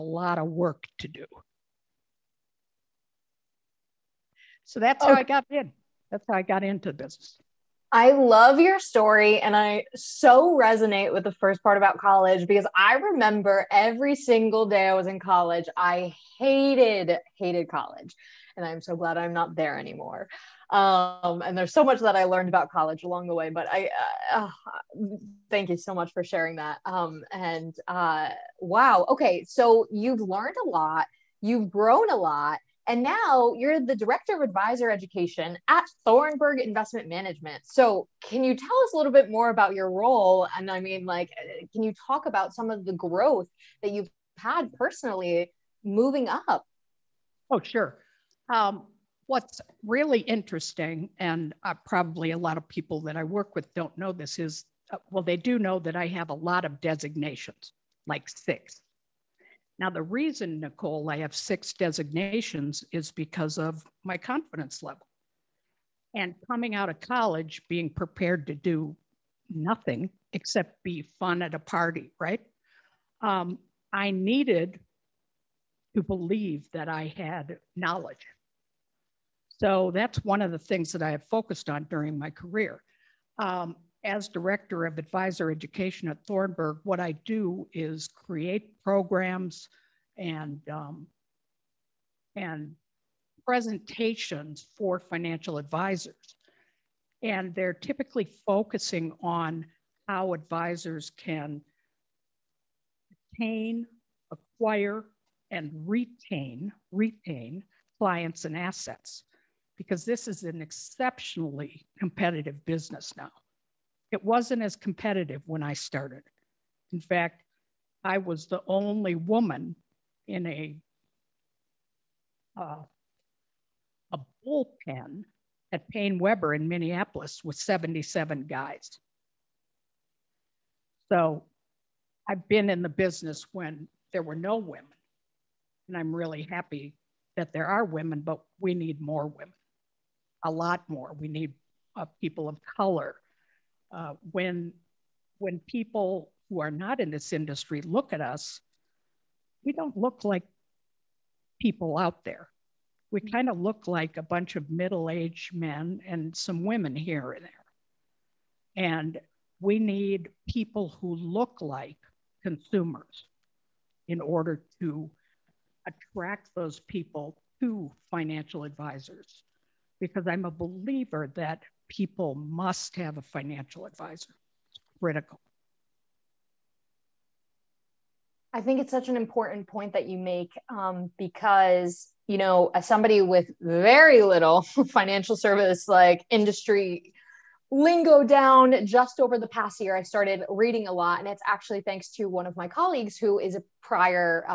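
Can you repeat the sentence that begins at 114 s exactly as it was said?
It wasn't as competitive when I started.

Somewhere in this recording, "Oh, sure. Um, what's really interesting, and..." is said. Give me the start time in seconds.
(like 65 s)
47 s.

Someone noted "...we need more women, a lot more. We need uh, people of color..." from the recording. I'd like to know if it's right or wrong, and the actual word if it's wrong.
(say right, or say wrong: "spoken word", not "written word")
right.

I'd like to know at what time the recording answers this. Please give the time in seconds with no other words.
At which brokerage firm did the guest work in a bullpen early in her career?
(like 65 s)
125 s.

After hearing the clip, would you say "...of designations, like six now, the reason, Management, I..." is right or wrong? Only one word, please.
wrong.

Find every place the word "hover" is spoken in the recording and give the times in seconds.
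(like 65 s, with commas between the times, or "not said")
not said.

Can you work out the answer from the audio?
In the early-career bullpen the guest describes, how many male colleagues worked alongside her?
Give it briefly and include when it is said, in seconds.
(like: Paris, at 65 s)
77, at 127 s.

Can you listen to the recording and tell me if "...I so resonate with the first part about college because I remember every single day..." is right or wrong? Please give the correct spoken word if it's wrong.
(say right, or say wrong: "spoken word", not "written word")
right.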